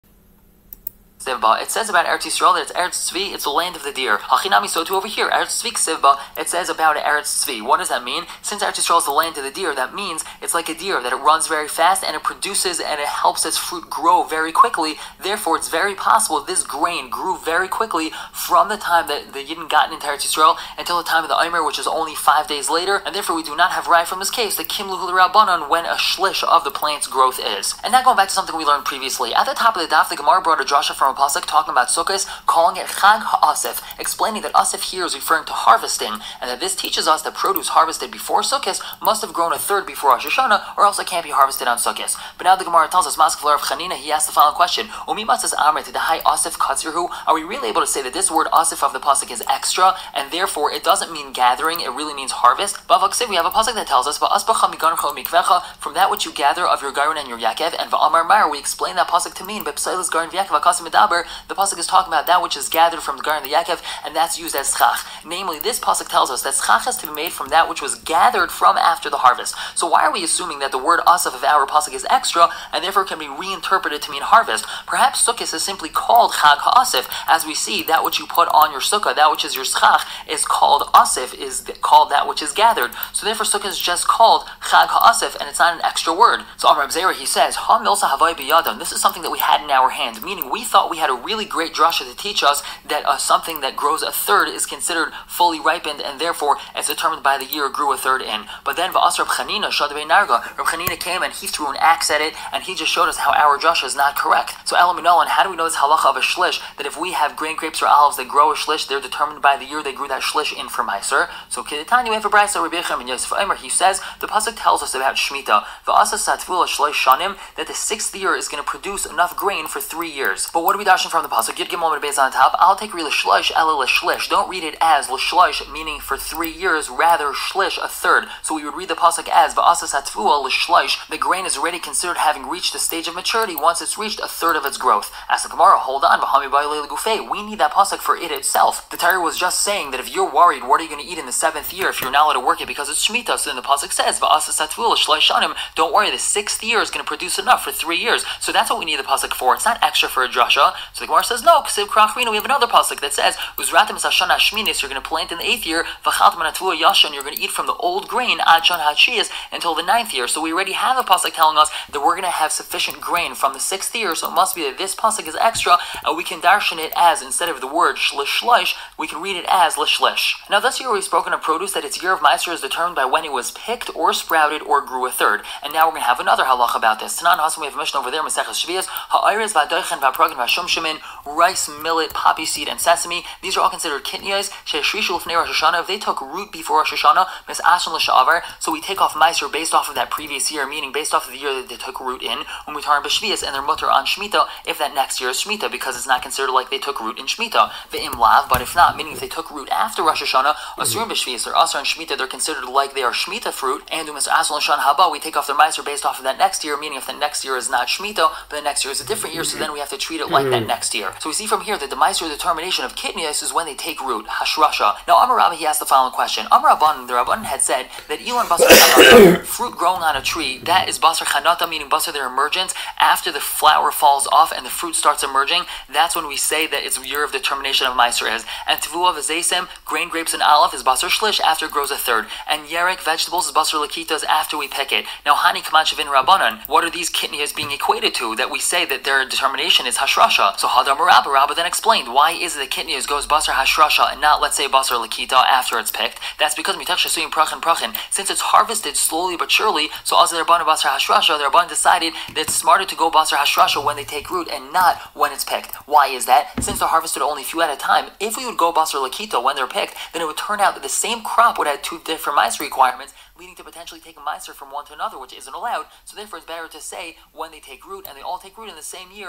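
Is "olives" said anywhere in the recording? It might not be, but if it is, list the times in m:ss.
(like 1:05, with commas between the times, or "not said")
1:47, 3:50.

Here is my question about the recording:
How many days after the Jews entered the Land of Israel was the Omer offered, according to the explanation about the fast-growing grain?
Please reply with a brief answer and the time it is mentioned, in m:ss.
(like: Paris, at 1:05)
5 days, at 0:22.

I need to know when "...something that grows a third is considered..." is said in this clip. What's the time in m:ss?
1:33.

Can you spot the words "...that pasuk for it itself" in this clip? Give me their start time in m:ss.
2:17.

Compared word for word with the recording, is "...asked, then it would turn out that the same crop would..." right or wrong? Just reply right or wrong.
wrong.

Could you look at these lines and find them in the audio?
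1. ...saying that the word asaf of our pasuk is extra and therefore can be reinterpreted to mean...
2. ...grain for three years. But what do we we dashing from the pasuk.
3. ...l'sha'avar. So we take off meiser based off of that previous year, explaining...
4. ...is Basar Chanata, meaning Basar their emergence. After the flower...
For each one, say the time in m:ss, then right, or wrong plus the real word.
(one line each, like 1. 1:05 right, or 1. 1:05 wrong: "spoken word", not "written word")
1. 1:10 wrong: "assuming", not "saying"
2. 1:59 right
3. 3:07 wrong: "meaning", not "explaining"
4. 3:40 right.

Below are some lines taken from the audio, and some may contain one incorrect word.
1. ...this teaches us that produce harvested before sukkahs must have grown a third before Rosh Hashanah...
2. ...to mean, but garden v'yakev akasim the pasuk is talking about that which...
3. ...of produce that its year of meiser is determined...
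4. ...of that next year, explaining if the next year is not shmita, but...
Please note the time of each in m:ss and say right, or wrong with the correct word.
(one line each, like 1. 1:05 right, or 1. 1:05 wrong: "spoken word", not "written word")
1. 0:36 right
2. 0:59 right
3. 2:51 right
4. 3:26 wrong: "meaning", not "explaining".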